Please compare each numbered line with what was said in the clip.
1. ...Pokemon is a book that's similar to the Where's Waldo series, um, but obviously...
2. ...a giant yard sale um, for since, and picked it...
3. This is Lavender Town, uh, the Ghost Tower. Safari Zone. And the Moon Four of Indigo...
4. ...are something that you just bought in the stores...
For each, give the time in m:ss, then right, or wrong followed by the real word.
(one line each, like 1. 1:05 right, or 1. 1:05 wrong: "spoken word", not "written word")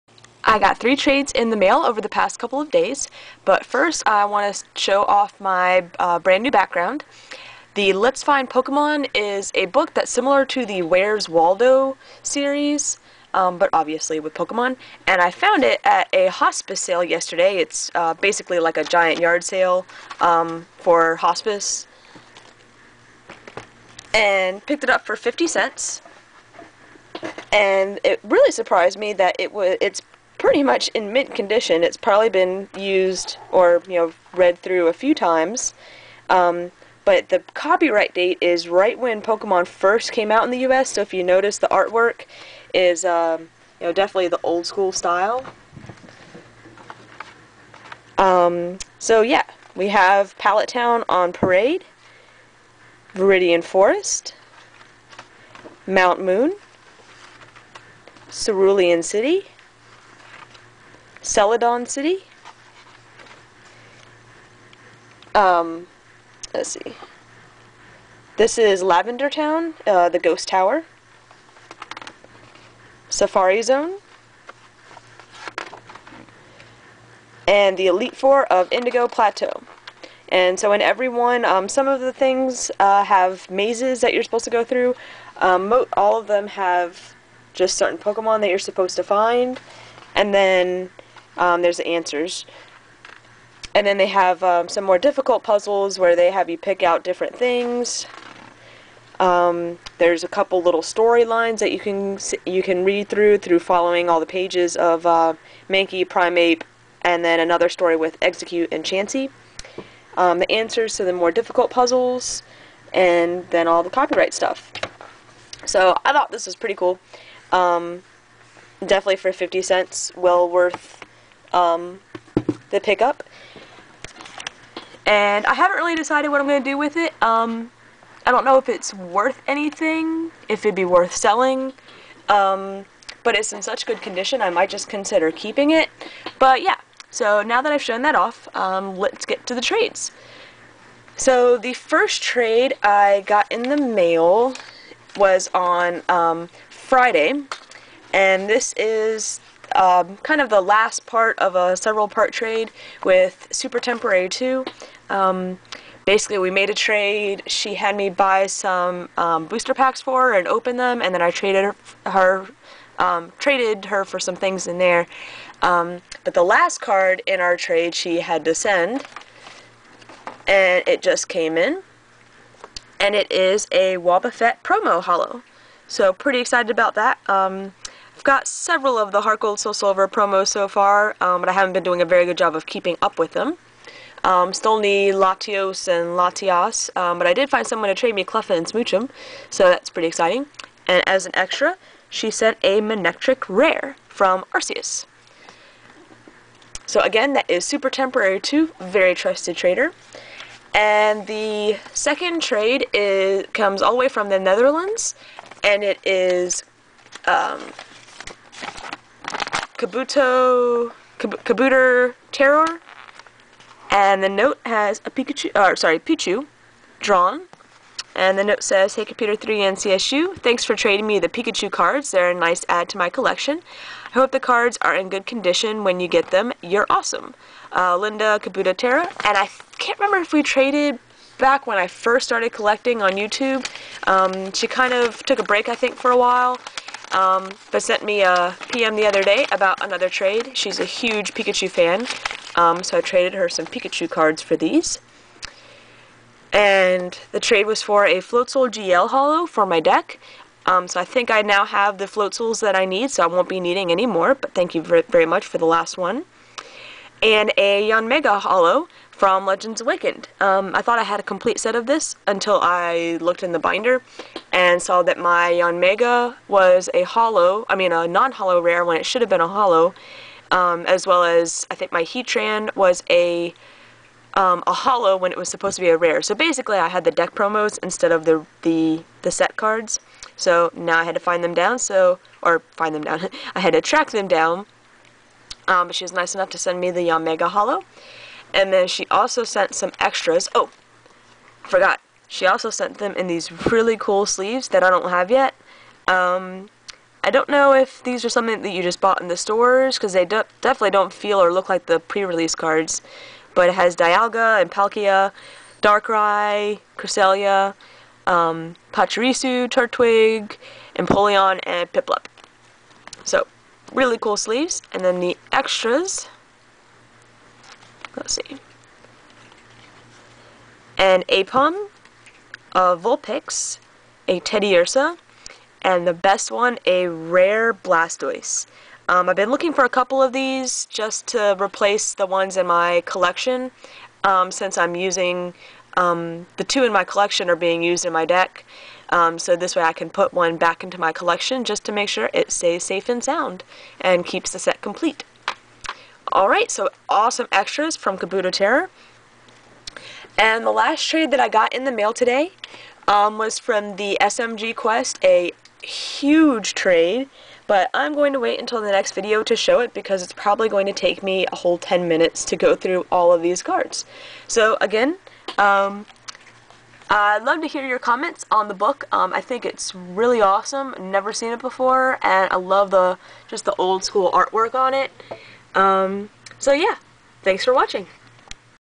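1. 0:08 right
2. 0:18 wrong: "hospice", not "since"
3. 1:08 wrong: "Elite", not "Moon"
4. 4:58 right.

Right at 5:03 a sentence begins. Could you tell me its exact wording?
But it has Dialga and Palkia, Darkrai, Cresselia, um, Pachirisu, Turtwig, Empoleon, and Piplup.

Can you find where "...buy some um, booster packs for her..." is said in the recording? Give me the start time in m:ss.
2:38.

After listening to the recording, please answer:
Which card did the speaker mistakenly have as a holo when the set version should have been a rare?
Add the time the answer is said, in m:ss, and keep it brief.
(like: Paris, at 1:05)
Heatran, at 4:32.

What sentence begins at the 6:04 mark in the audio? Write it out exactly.
So again, um, I'd love to hear your comments on the book.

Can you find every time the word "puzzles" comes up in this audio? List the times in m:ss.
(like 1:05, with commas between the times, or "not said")
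1:35, 1:51.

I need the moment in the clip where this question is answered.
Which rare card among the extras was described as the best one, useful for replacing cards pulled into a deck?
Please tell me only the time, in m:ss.
5:27.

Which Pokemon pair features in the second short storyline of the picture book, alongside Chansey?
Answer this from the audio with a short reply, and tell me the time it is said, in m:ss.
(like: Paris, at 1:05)
Exeggcute, at 1:48.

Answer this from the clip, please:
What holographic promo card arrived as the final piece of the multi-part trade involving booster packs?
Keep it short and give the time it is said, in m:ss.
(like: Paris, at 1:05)
Wobbuffet, at 2:53.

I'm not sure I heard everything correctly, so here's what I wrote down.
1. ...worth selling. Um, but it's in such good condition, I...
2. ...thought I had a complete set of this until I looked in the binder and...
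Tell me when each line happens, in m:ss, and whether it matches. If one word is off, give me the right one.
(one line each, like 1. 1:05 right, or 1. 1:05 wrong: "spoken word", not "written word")
1. 2:10 right
2. 4:20 right.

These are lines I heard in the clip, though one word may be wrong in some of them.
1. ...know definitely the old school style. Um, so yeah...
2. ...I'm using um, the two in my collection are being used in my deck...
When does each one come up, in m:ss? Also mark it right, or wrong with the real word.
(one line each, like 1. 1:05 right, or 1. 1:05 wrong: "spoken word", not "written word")
1. 0:43 right
2. 5:34 right.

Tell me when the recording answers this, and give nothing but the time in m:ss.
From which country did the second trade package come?
3:24.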